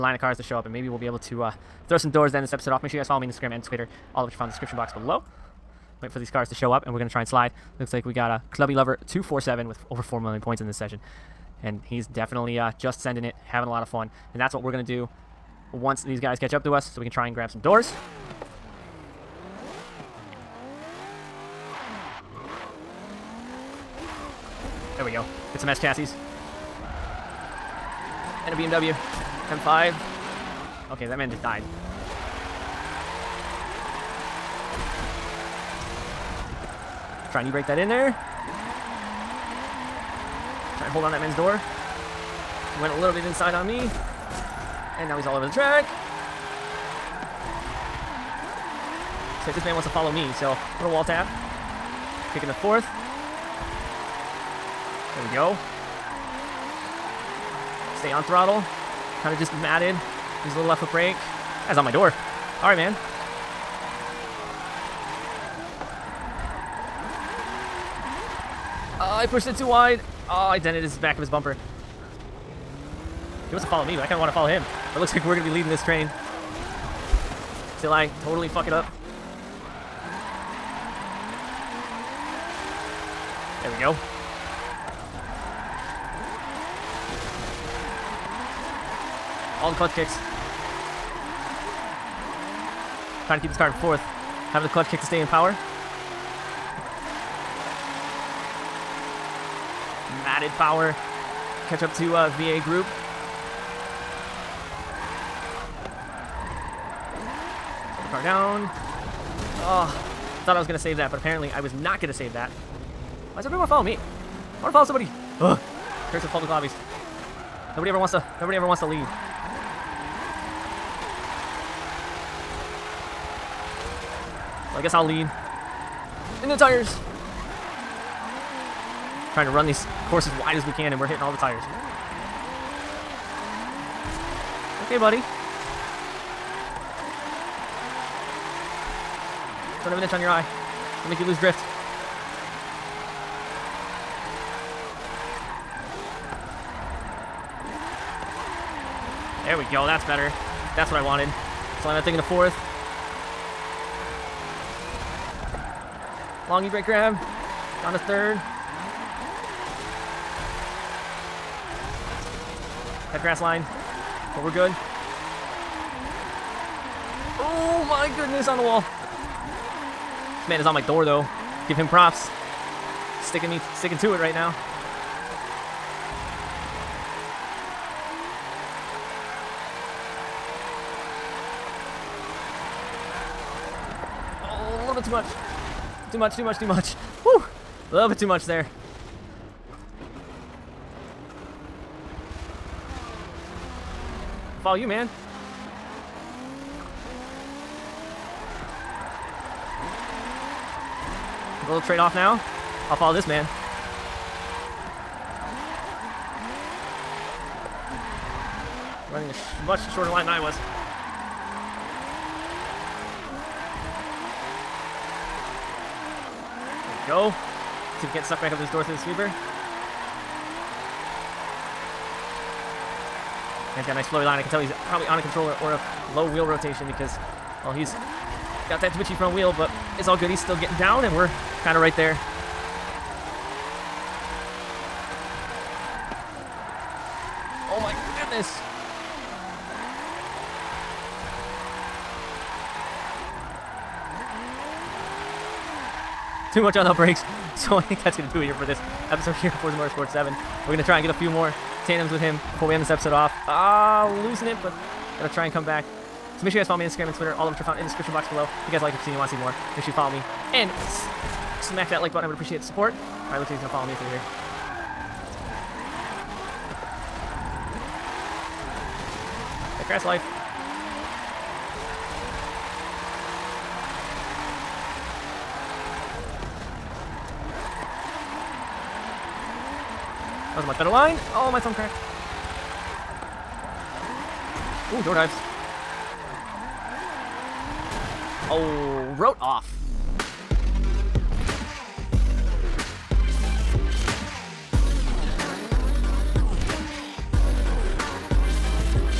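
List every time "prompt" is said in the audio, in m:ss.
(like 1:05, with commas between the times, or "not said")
not said.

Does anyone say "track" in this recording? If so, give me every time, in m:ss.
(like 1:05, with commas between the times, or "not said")
0:45.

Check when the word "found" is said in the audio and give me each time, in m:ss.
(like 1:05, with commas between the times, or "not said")
0:04, 4:17.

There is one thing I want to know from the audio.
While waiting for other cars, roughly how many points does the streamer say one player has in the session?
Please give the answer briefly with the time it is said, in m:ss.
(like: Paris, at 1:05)
over 4 million, at 0:09.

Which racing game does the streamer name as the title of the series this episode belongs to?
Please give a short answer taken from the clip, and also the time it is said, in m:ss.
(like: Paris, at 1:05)
Forza Motorsport 7, at 4:09.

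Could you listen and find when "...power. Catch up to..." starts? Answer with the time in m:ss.
1:40.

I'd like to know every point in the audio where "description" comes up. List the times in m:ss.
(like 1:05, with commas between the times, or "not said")
0:04, 4:17.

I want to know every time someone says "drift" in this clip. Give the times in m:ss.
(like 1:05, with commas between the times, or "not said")
2:21.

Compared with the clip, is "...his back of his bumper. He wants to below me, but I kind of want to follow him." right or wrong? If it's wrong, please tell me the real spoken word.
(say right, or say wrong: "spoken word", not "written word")
wrong: "follow", not "below".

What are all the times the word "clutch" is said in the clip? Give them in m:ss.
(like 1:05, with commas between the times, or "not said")
1:29, 1:34.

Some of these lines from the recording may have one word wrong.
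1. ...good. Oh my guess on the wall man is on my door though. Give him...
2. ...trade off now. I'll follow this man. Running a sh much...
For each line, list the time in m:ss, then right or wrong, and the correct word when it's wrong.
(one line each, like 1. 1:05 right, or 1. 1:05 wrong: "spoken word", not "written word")
1. 2:44 wrong: "goodness", not "guess"
2. 3:21 right.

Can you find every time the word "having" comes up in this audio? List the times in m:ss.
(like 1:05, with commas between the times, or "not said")
0:13, 1:34.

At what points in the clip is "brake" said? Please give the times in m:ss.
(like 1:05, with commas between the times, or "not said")
1:00, 2:36, 4:06.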